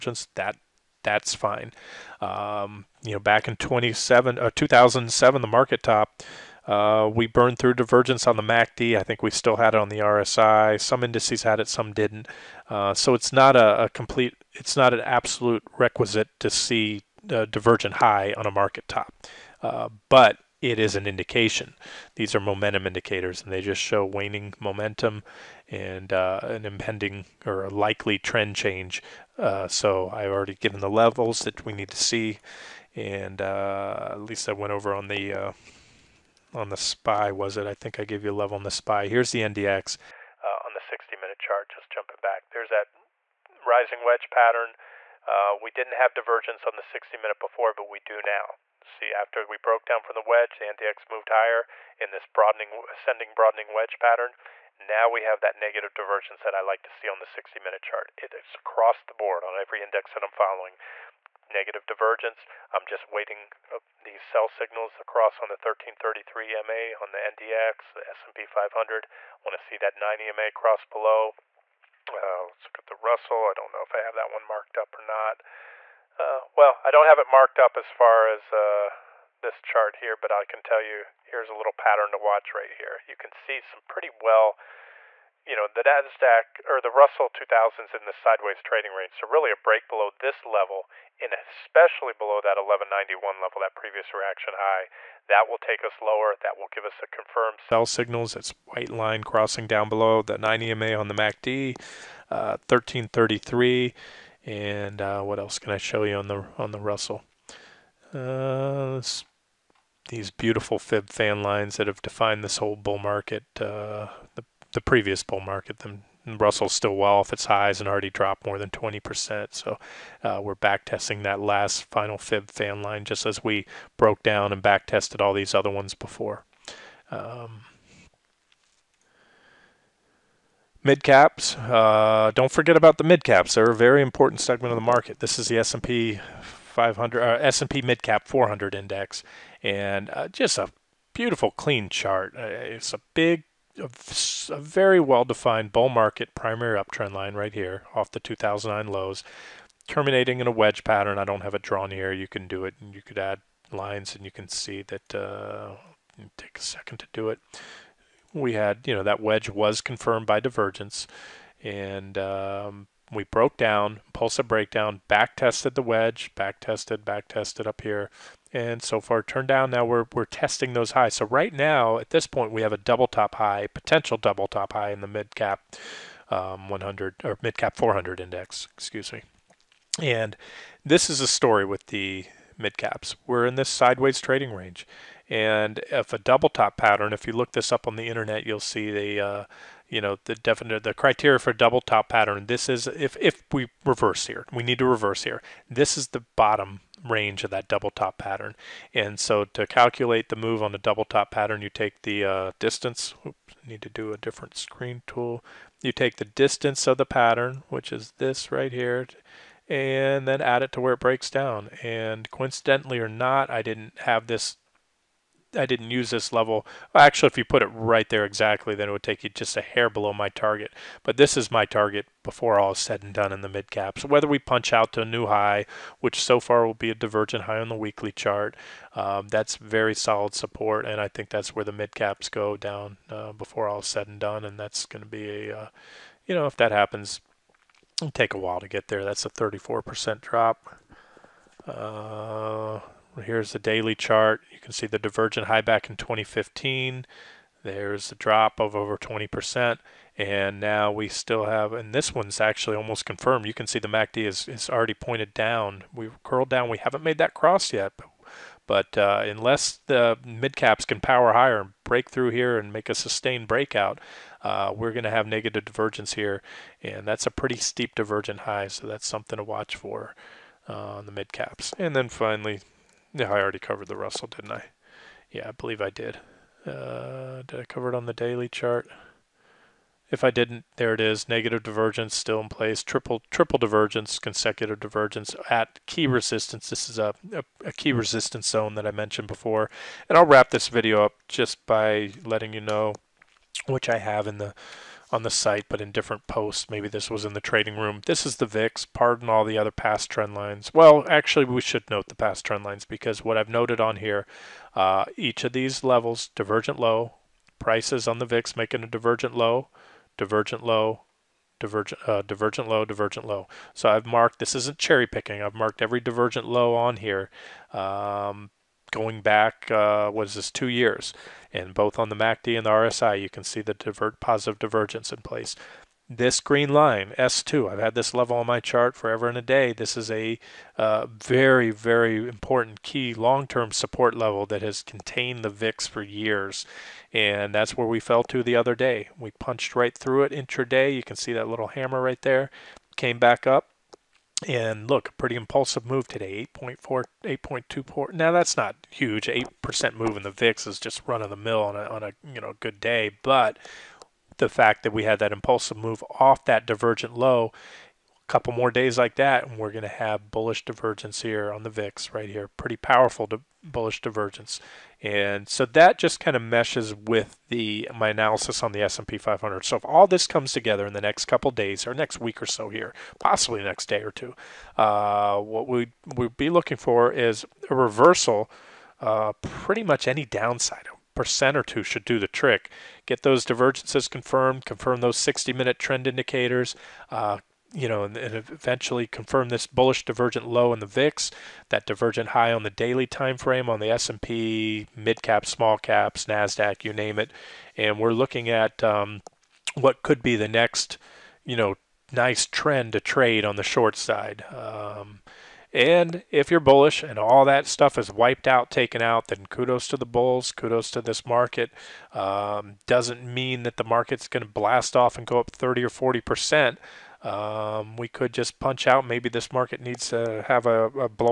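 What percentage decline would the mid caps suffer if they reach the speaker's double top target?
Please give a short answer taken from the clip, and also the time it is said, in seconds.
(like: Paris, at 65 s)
34%, at 239 s.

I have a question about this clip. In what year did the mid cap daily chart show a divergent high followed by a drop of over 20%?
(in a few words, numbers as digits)
2015.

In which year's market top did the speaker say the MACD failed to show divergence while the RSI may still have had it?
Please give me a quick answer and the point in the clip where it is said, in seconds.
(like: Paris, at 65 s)
2007, at 4 s.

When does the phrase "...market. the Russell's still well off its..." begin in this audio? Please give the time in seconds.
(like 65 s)
115 s.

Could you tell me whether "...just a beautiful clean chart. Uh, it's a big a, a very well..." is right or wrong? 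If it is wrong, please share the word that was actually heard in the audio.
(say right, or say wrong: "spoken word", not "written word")
right.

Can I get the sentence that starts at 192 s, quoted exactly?
This is, if, if we reverse here, we need to reverse here.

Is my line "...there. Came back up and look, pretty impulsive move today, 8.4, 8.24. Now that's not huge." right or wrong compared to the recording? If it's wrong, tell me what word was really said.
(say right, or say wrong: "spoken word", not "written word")
right.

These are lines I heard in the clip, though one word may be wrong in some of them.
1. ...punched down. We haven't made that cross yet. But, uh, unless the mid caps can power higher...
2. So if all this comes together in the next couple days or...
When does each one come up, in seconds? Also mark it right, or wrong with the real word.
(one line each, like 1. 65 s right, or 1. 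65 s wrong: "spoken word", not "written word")
1. 256 s wrong: "curled", not "punched"
2. 369 s right.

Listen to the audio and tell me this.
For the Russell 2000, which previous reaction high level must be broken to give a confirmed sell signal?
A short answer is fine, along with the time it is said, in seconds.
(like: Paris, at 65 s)
1191, at 92 s.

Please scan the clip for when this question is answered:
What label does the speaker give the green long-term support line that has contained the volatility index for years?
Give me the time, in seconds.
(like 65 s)
327 s.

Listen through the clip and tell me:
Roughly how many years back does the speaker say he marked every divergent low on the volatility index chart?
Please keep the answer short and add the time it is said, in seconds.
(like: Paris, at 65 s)
2 years, at 320 s.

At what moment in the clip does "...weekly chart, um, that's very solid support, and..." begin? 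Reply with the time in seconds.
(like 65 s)
227 s.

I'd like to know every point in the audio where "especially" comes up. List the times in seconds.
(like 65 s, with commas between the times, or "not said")
91 s.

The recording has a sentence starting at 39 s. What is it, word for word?
Here's the NDX uh, on the 60 minute chart, just jumping back.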